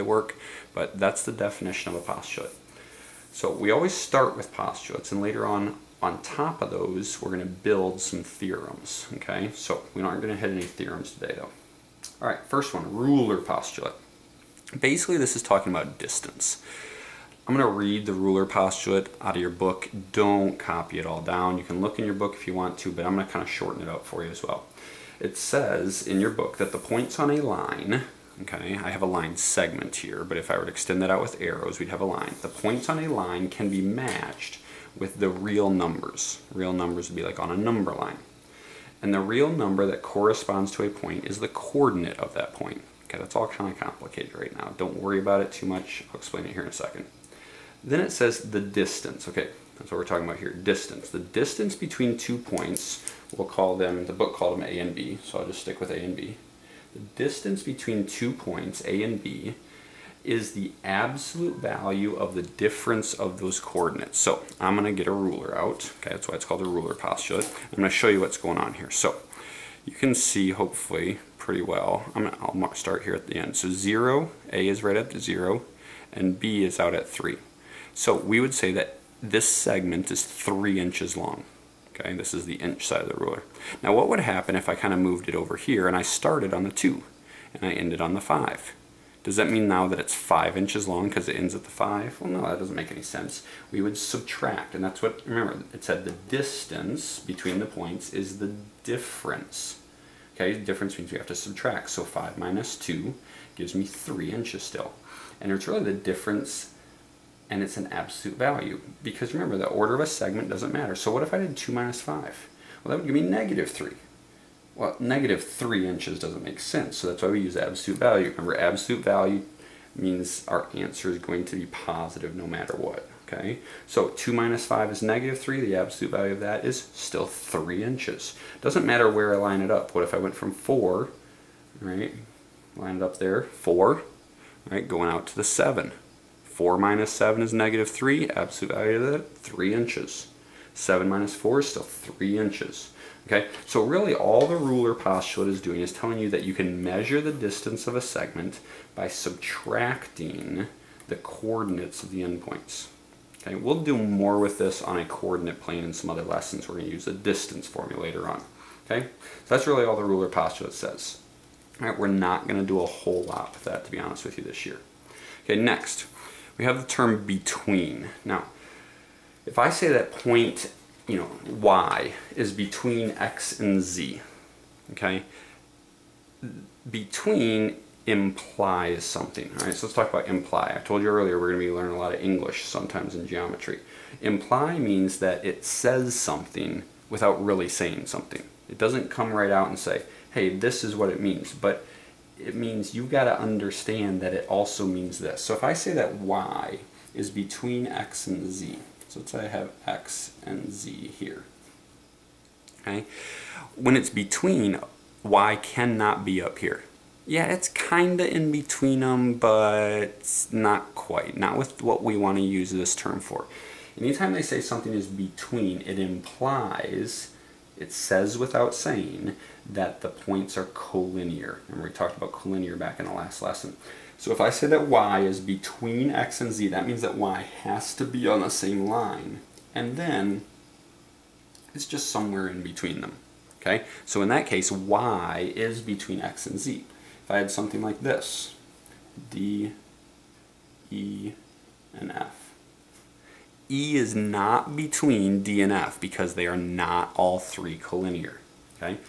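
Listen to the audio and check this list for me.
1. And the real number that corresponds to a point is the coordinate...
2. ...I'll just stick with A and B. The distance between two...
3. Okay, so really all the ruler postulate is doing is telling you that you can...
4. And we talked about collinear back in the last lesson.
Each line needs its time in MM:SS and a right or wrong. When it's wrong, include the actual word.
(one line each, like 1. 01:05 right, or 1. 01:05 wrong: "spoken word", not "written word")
1. 00:39 right
2. 00:55 right
3. 02:23 right
4. 03:41 right.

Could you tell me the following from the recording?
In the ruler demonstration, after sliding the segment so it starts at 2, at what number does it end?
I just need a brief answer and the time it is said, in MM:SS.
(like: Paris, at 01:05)
5, at 01:27.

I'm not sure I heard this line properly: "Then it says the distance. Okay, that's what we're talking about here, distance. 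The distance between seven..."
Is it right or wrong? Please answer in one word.
wrong.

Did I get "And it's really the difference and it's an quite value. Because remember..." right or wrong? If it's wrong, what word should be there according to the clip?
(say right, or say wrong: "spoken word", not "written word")
wrong: "absolute", not "quite".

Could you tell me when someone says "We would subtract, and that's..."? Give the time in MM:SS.
01:33.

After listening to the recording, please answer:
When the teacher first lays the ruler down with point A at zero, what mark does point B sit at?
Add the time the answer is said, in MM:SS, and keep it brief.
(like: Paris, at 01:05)
3, at 01:16.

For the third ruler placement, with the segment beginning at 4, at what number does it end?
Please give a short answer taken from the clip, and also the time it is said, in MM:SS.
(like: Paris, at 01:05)
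7, at 02:14.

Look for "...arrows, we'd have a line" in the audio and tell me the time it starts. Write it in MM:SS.
00:31.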